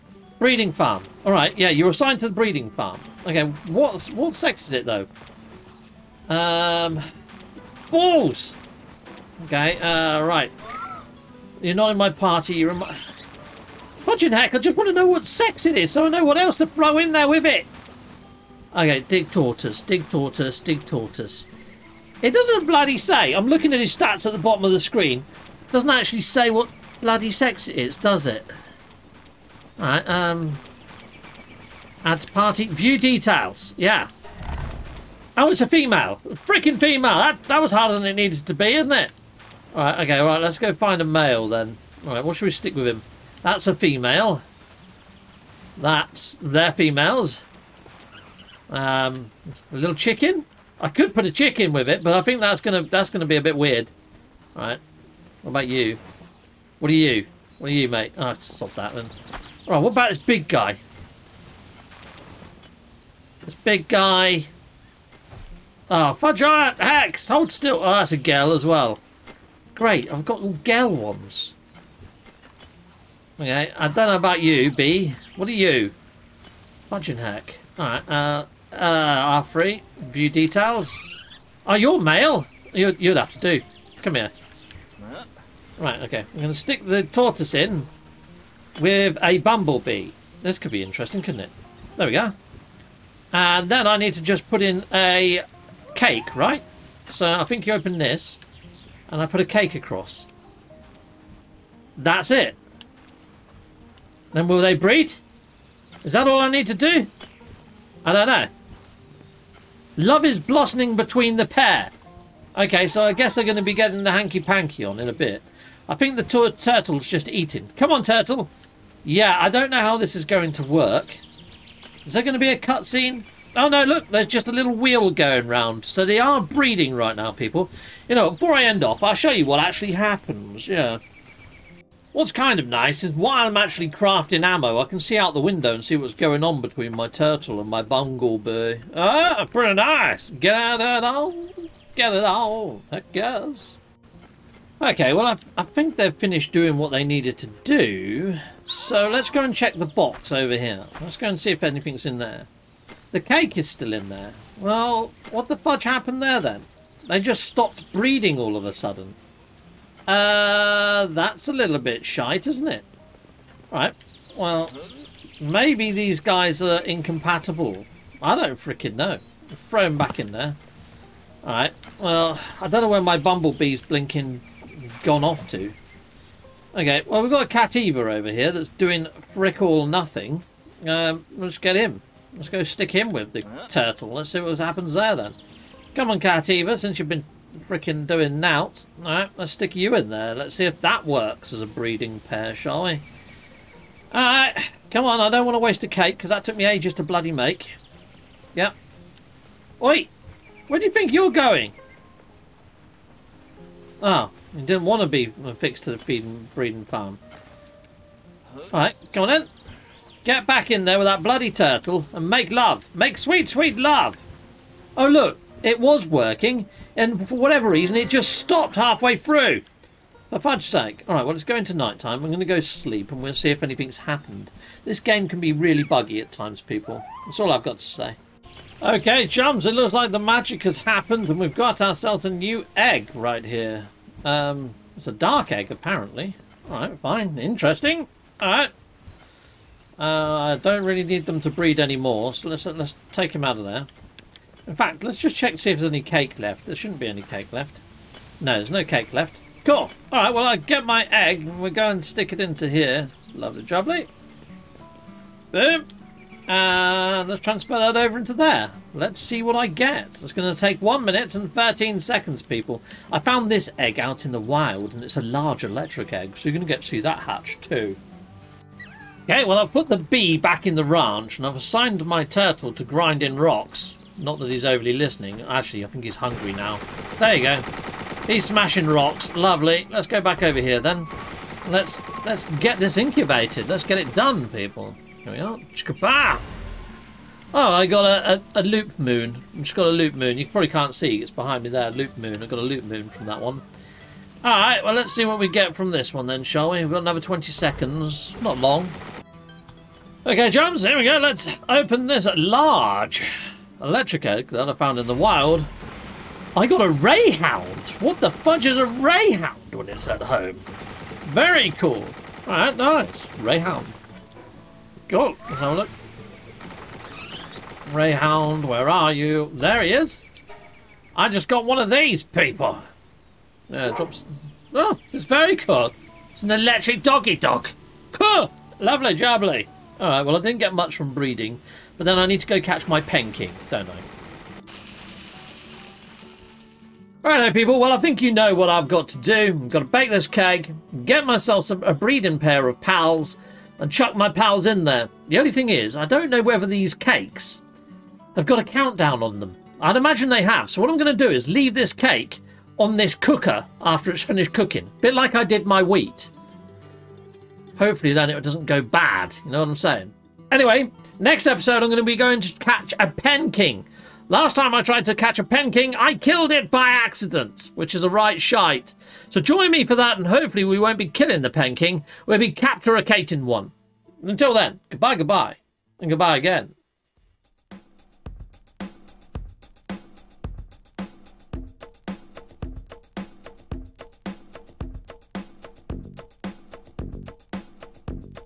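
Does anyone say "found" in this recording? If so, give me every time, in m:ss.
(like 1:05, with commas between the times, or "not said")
4:23, 5:04.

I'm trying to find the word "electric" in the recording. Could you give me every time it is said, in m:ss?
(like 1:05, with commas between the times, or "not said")
4:25, 5:03, 5:26.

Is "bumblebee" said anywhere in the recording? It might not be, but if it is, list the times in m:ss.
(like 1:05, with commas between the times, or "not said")
1:29, 2:17, 2:53.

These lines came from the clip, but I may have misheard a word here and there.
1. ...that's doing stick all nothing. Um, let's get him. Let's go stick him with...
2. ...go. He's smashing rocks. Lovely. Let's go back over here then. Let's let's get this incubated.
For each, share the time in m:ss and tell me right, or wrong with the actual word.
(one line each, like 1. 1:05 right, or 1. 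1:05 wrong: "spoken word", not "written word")
1. 2:58 wrong: "frick", not "stick"
2. 4:37 right.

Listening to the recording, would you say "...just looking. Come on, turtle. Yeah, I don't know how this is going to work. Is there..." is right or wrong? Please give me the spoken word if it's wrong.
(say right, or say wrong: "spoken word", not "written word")
wrong: "eating", not "looking".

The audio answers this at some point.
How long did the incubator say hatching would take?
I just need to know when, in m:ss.
4:20.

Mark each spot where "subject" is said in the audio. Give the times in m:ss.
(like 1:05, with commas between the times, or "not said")
not said.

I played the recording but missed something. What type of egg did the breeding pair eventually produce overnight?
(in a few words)
Dark egg.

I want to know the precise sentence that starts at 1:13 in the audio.
Okay, I don't know about you, B.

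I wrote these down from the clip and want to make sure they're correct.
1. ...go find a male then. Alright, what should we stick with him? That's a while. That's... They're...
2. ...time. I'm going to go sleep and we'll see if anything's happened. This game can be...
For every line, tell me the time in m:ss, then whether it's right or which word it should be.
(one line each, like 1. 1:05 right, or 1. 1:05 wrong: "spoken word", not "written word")
1. 0:40 wrong: "female", not "while"
2. 3:41 right.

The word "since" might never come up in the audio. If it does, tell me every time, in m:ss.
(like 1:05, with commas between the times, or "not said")
3:06.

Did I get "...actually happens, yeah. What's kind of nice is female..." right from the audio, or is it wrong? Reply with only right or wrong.
wrong.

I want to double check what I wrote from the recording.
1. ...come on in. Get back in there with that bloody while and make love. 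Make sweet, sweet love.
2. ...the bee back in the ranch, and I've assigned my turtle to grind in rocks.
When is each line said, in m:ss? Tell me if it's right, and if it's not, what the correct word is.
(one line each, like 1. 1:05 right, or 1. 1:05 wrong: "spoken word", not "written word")
1. 3:29 wrong: "turtle", not "while"
2. 4:29 right.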